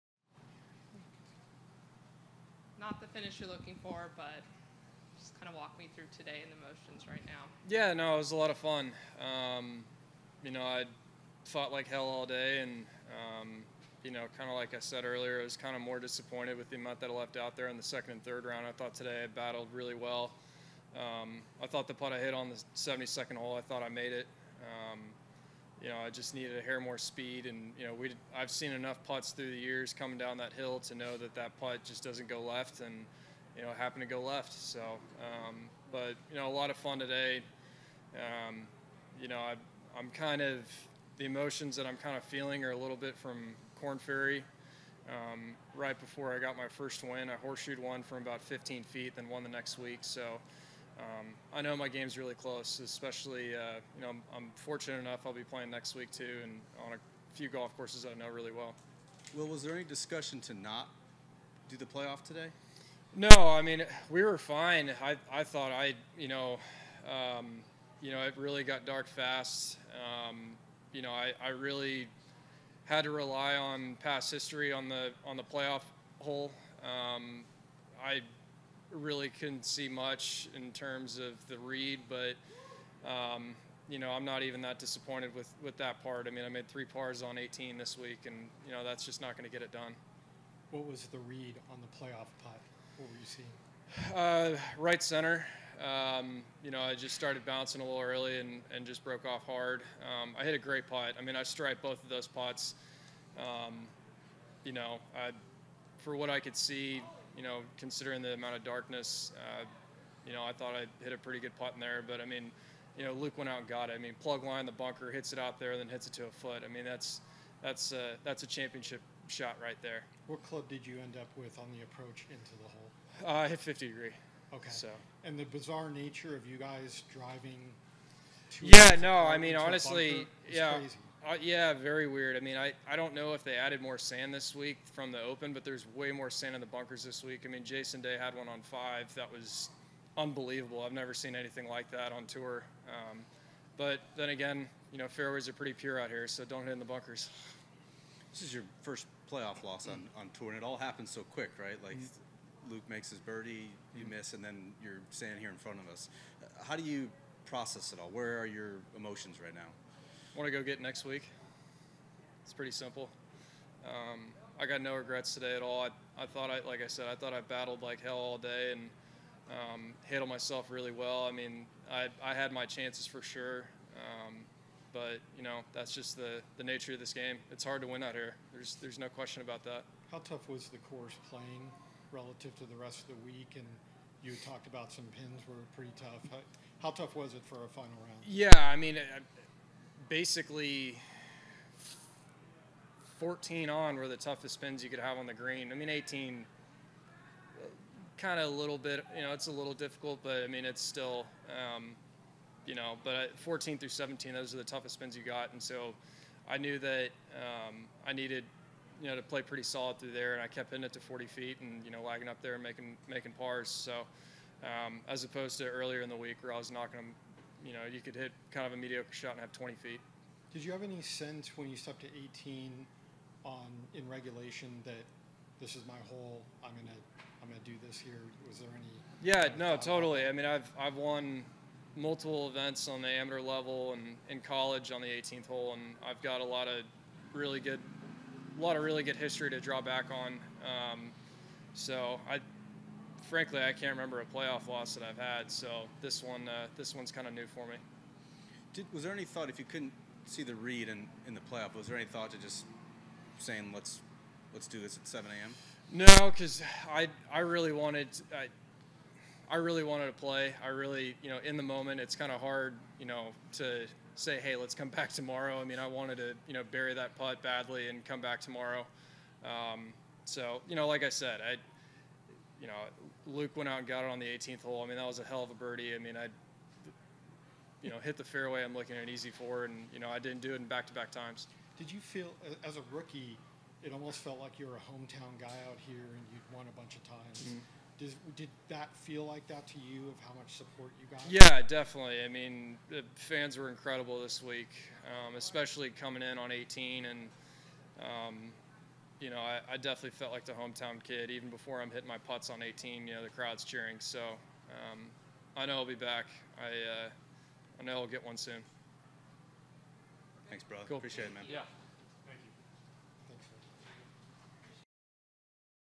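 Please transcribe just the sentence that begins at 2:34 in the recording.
miss, and then you're standing here in front of us.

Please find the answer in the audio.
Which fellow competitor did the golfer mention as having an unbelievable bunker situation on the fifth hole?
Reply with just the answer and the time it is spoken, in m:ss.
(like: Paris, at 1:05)
Jason Day, at 2:17.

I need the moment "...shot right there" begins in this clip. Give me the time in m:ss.
1:59.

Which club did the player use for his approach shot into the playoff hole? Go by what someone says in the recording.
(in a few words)
50 degree.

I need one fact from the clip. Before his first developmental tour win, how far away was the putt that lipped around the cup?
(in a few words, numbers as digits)
15 feet.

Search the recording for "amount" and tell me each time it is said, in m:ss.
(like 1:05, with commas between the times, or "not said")
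0:16, 1:48.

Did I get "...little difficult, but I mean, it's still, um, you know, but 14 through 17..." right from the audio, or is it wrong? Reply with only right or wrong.
right.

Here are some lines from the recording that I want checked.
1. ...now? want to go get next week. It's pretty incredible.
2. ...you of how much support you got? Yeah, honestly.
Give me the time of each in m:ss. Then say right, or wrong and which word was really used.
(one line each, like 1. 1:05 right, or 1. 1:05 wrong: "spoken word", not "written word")
1. 2:39 wrong: "simple", not "incredible"
2. 4:49 wrong: "definitely", not "honestly".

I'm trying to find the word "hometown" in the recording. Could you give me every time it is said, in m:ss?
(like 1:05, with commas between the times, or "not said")
4:44, 5:00.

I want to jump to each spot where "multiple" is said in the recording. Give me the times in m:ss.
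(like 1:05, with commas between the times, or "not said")
3:51.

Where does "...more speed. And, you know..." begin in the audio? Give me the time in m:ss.
0:26.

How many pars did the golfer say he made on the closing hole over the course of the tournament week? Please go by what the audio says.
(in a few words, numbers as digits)
3.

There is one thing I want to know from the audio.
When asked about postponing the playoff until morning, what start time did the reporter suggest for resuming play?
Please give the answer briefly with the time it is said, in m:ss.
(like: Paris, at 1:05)
7 a.m., at 4:15.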